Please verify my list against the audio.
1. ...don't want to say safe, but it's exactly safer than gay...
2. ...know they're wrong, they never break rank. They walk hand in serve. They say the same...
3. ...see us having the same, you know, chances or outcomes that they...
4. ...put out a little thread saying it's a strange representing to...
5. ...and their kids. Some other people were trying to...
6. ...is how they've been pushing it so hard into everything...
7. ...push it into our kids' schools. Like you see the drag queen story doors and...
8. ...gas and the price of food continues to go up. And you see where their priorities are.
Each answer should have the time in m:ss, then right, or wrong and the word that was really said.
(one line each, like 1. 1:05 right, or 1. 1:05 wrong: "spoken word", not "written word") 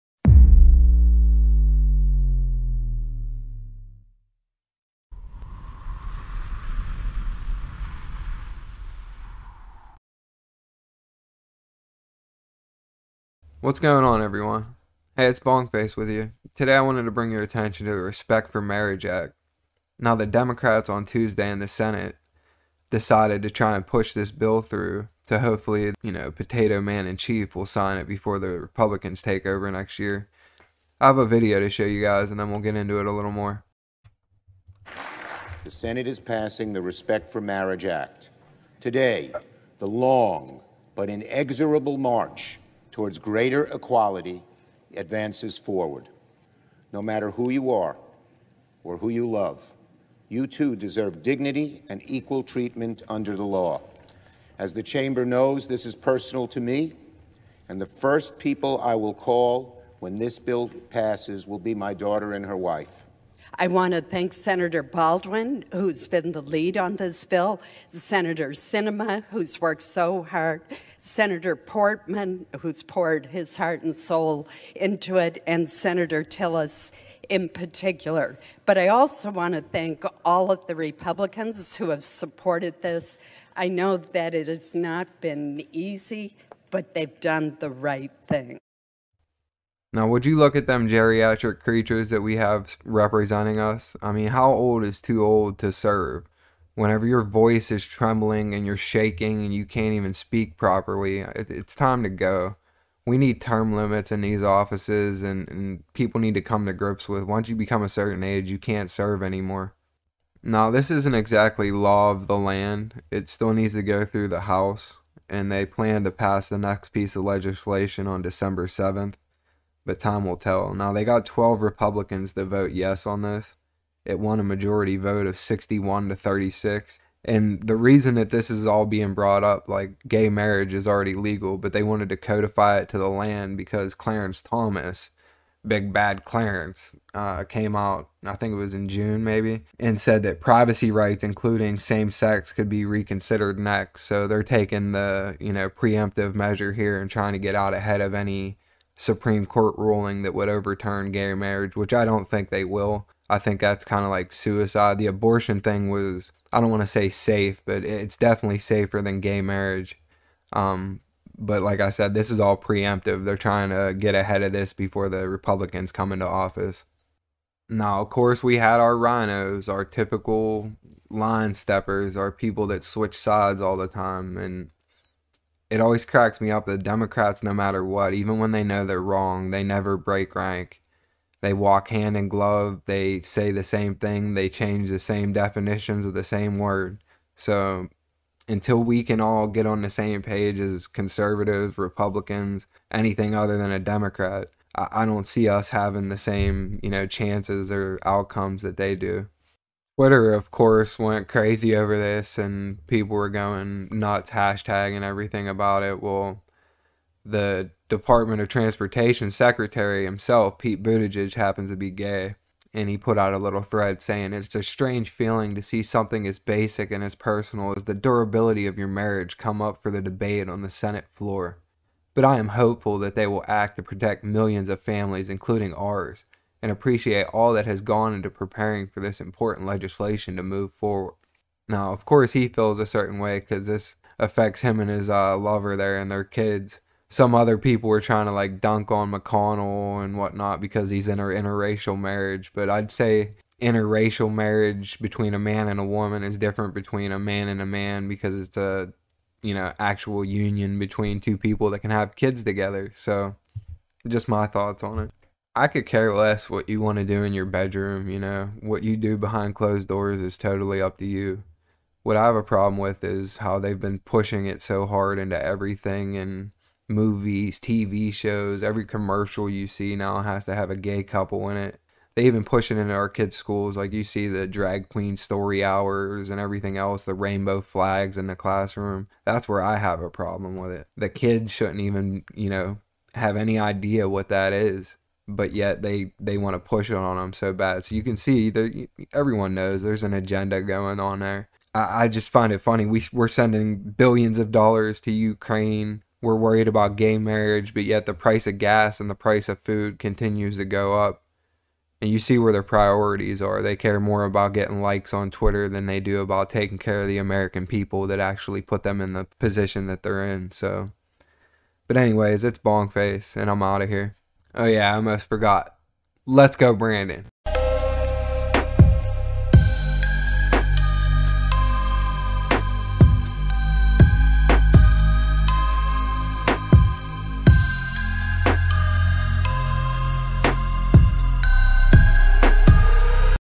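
1. 2:36 wrong: "definitely", not "exactly"
2. 2:58 wrong: "glove", not "serve"
3. 3:15 right
4. 3:32 wrong: "feeling", not "representing"
5. 3:55 right
6. 4:23 right
7. 4:32 wrong: "hours", not "doors"
8. 4:58 right.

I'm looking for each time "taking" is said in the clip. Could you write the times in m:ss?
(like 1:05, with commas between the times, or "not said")
2:24, 5:06.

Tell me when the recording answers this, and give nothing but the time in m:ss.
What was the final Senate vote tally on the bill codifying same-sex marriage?
2:05.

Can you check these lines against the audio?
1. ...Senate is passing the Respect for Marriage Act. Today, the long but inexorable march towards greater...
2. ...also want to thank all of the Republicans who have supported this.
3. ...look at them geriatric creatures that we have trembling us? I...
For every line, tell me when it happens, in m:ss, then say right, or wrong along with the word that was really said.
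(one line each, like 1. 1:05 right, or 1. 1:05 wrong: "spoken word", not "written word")
1. 0:35 right
2. 1:18 right
3. 1:30 wrong: "representing", not "trembling".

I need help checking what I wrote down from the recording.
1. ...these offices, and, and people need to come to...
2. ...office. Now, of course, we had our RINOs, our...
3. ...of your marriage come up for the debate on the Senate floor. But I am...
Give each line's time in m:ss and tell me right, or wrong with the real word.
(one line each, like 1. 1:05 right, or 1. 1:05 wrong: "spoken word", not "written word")
1. 1:44 right
2. 2:46 right
3. 3:38 right.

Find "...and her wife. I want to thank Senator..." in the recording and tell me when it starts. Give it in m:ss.
1:02.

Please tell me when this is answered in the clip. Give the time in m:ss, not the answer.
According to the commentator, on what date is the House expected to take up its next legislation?
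1:58.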